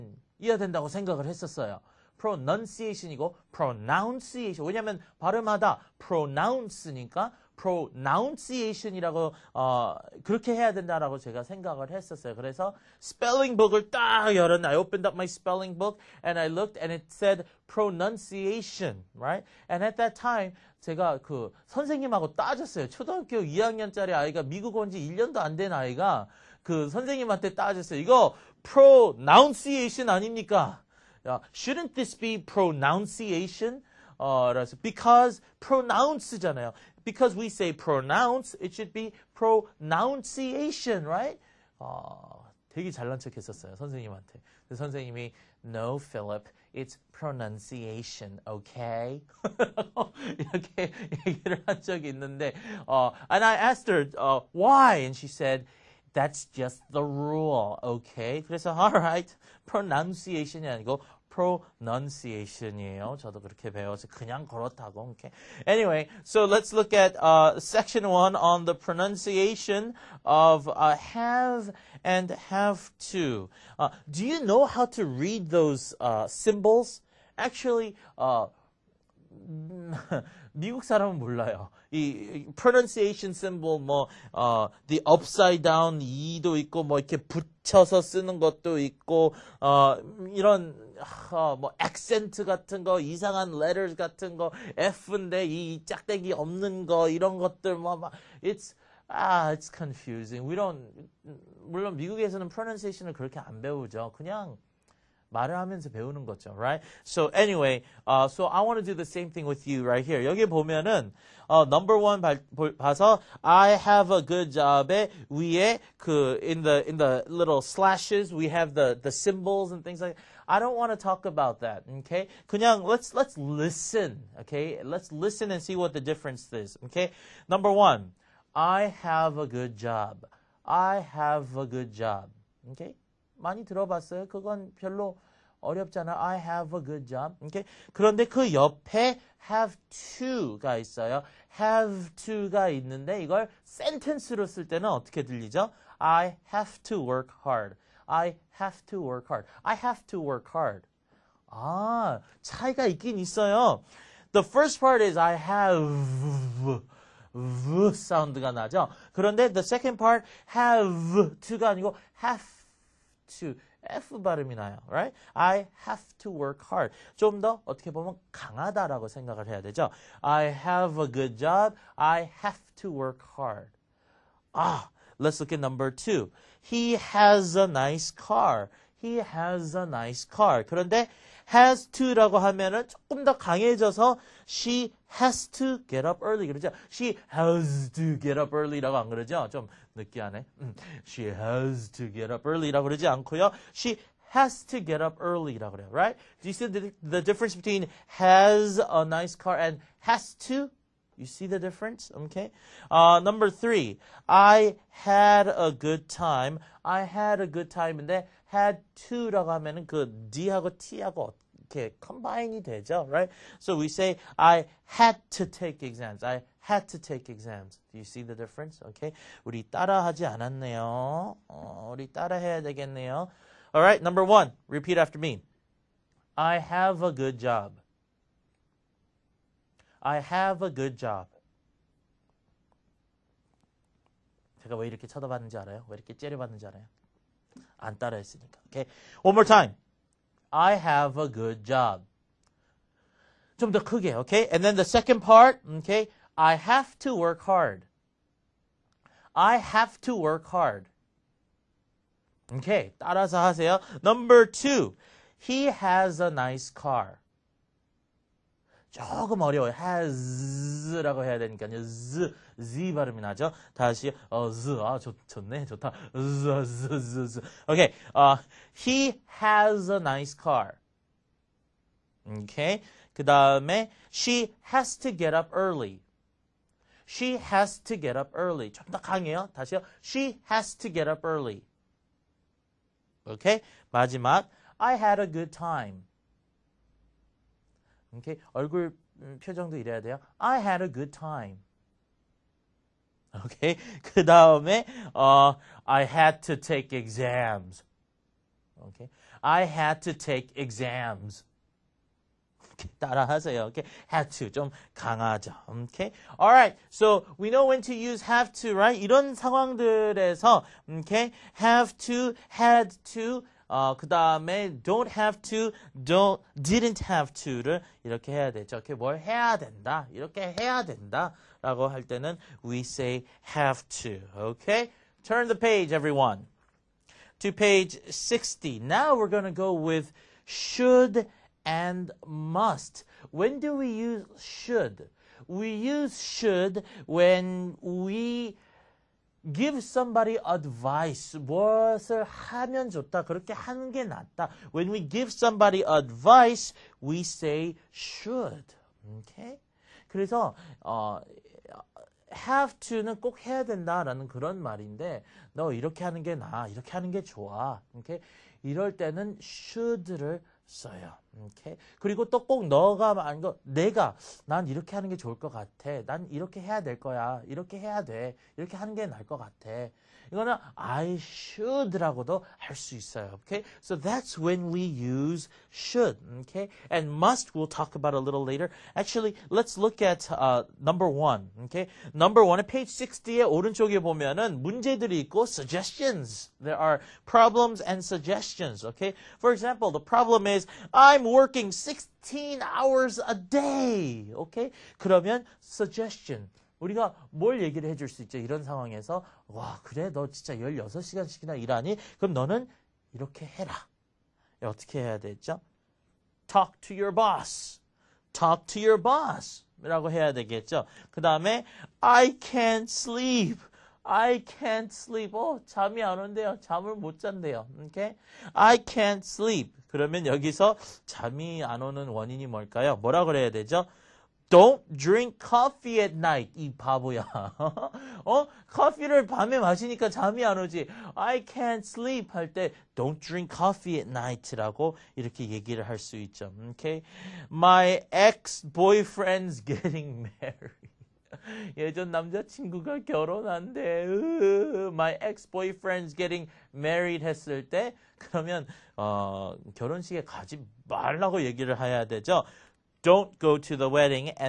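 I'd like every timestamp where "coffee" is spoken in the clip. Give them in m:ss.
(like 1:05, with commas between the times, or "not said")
7:05, 7:13.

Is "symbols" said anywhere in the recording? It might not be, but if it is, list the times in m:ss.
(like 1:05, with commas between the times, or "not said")
1:16, 1:23, 1:59.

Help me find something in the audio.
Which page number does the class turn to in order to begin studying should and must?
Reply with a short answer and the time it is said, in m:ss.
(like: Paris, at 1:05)
60, at 5:27.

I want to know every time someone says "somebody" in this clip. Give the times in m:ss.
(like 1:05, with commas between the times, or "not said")
5:39, 5:45.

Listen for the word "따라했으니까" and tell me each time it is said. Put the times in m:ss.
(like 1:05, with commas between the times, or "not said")
3:57.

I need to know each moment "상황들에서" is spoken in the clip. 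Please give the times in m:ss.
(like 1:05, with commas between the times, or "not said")
5:09.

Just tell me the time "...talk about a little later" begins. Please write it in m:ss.
6:17.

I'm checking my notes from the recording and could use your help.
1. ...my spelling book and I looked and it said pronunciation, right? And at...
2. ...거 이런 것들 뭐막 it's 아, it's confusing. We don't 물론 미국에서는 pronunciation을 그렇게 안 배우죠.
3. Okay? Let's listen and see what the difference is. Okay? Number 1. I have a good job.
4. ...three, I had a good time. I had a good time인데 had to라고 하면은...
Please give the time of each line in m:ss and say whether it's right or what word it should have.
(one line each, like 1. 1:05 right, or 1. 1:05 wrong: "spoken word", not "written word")
1. 0:15 right
2. 1:36 right
3. 2:04 right
4. 3:23 right.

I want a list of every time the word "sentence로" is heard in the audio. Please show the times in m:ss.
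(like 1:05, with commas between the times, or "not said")
2:23.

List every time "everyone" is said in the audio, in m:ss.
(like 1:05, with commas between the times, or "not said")
5:25.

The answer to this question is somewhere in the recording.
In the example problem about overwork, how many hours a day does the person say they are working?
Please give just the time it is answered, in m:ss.
6:31.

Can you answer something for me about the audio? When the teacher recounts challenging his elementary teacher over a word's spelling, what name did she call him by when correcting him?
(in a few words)
Philip.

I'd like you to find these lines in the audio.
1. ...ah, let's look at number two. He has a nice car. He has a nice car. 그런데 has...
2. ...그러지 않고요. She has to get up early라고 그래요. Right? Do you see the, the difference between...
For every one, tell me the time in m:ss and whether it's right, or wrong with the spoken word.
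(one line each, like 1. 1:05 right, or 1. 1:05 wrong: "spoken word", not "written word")
1. 2:54 right
2. 3:12 right.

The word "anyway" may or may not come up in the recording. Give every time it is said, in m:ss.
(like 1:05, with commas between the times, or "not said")
1:05, 1:47.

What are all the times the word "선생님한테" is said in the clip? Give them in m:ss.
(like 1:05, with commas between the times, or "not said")
0:26, 0:43.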